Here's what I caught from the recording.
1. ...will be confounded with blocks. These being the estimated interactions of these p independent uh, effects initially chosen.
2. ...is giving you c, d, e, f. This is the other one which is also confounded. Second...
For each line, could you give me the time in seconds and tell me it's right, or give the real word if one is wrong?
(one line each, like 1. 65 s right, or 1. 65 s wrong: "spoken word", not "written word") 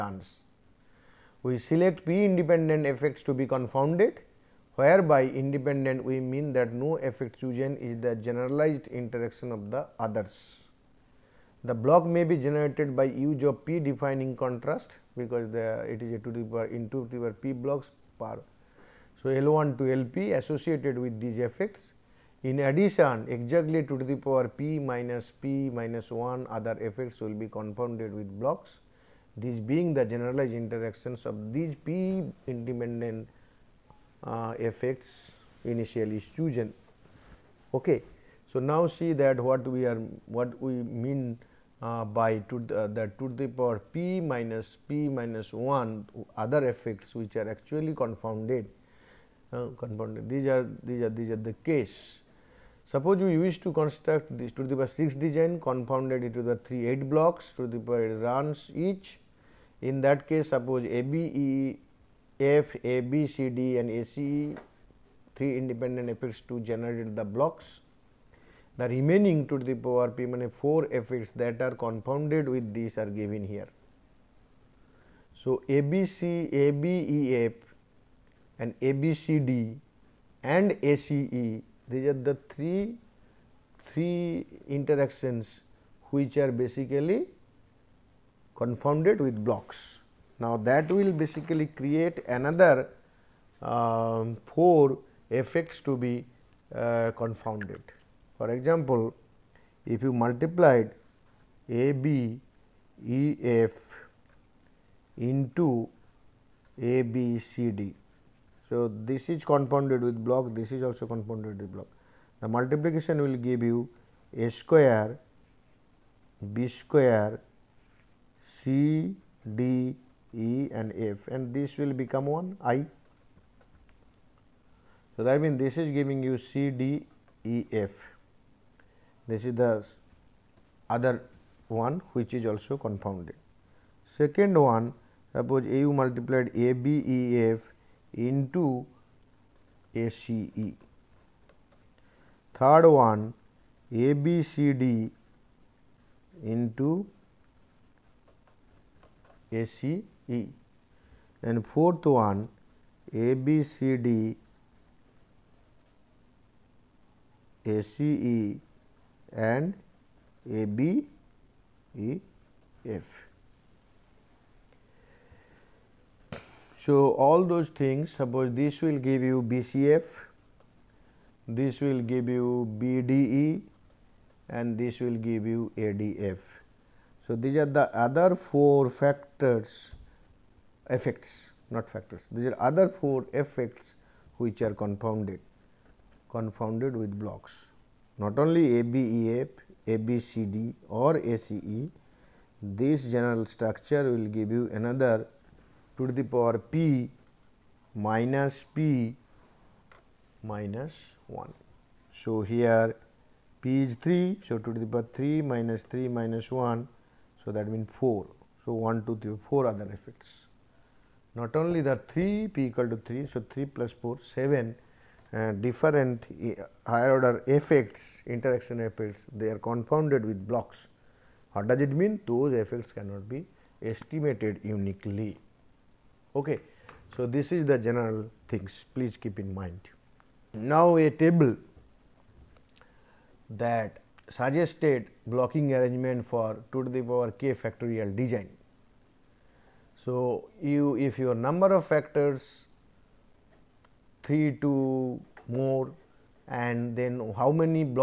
1. 27 s wrong: "generalized", not "estimated"
2. 125 s right.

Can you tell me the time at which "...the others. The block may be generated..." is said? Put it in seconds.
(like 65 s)
9 s.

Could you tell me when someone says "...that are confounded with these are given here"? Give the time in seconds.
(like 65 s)
71 s.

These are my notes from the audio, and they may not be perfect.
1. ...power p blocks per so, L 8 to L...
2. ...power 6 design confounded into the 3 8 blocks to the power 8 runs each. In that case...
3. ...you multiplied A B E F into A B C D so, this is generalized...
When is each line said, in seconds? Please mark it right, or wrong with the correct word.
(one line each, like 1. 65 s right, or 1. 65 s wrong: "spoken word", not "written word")
1. 17 s wrong: "1", not "8"
2. 54 s right
3. 100 s wrong: "confounded", not "generalized".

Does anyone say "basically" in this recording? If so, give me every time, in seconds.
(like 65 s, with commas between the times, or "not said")
86 s, 91 s.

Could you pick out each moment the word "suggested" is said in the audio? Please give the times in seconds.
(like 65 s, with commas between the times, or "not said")
234 s.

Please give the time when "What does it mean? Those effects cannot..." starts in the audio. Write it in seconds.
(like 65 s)
221 s.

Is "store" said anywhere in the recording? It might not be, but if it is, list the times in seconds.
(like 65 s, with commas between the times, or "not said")
not said.